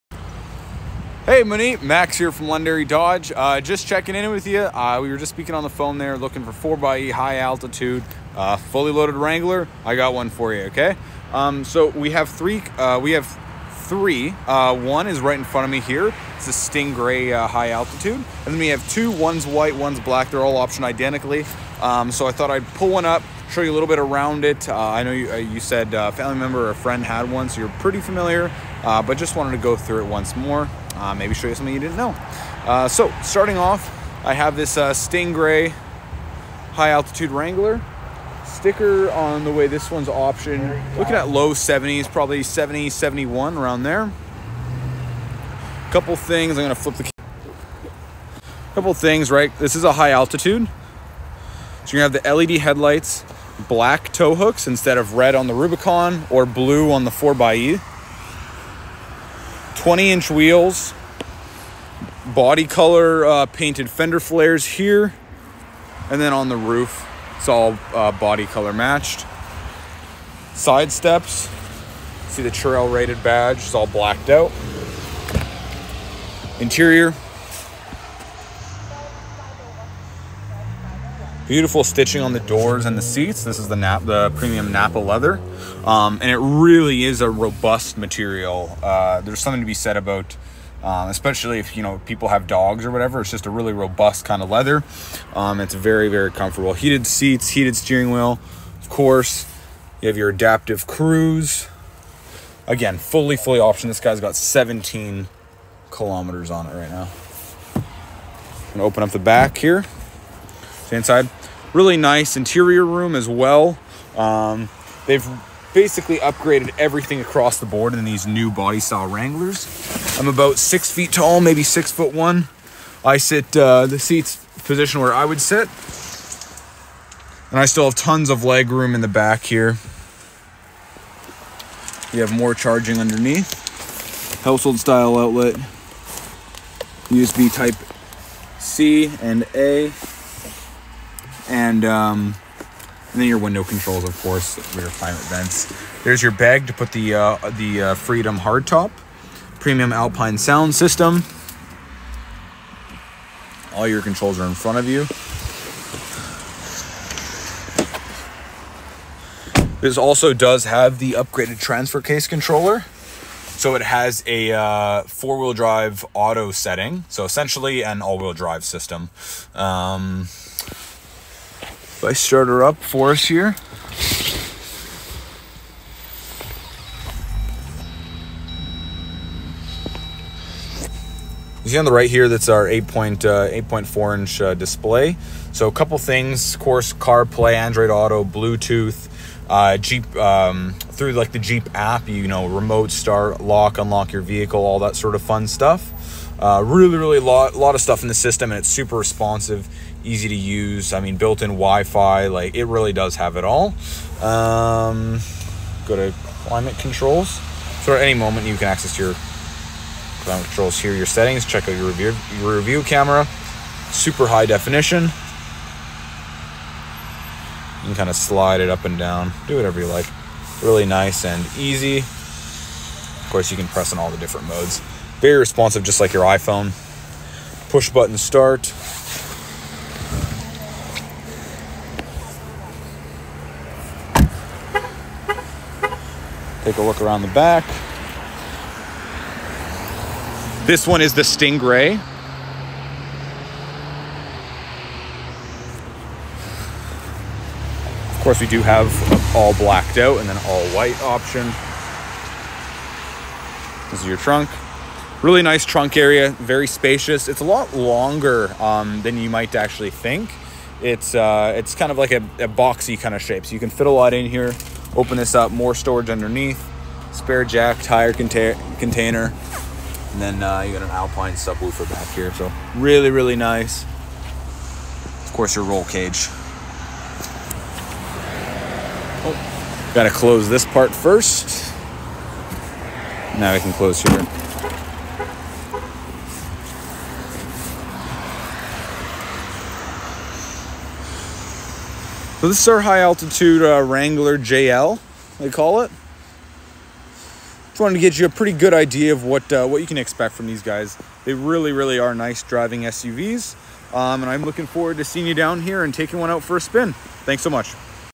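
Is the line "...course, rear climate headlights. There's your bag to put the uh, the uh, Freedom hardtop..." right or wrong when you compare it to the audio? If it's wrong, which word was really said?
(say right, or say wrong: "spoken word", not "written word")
wrong: "vents", not "headlights".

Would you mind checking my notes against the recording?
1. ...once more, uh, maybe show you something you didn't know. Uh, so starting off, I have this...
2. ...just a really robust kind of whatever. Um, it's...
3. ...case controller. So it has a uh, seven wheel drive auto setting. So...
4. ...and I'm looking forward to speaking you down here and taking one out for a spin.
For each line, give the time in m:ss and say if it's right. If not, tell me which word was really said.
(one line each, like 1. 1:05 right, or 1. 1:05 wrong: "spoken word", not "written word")
1. 0:30 right
2. 1:33 wrong: "leather", not "whatever"
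3. 2:42 wrong: "four", not "seven"
4. 5:04 wrong: "seeing", not "speaking".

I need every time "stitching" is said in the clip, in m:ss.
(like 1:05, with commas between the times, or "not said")
1:21.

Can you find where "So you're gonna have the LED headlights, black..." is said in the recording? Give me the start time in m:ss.
0:51.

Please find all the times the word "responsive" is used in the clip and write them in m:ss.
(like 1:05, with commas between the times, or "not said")
3:18, 3:45.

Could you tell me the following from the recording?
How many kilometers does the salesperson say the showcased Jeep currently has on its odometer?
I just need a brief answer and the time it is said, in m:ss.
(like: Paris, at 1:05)
17, at 1:44.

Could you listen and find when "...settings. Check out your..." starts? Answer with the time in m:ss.
3:31.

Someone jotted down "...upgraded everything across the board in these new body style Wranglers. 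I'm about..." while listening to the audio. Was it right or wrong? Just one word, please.
right.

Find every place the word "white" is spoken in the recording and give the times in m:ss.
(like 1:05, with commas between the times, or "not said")
0:19, 4:10.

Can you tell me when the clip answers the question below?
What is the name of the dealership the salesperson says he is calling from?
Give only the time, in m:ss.
0:02.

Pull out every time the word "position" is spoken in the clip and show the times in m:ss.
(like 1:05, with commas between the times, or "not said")
2:04.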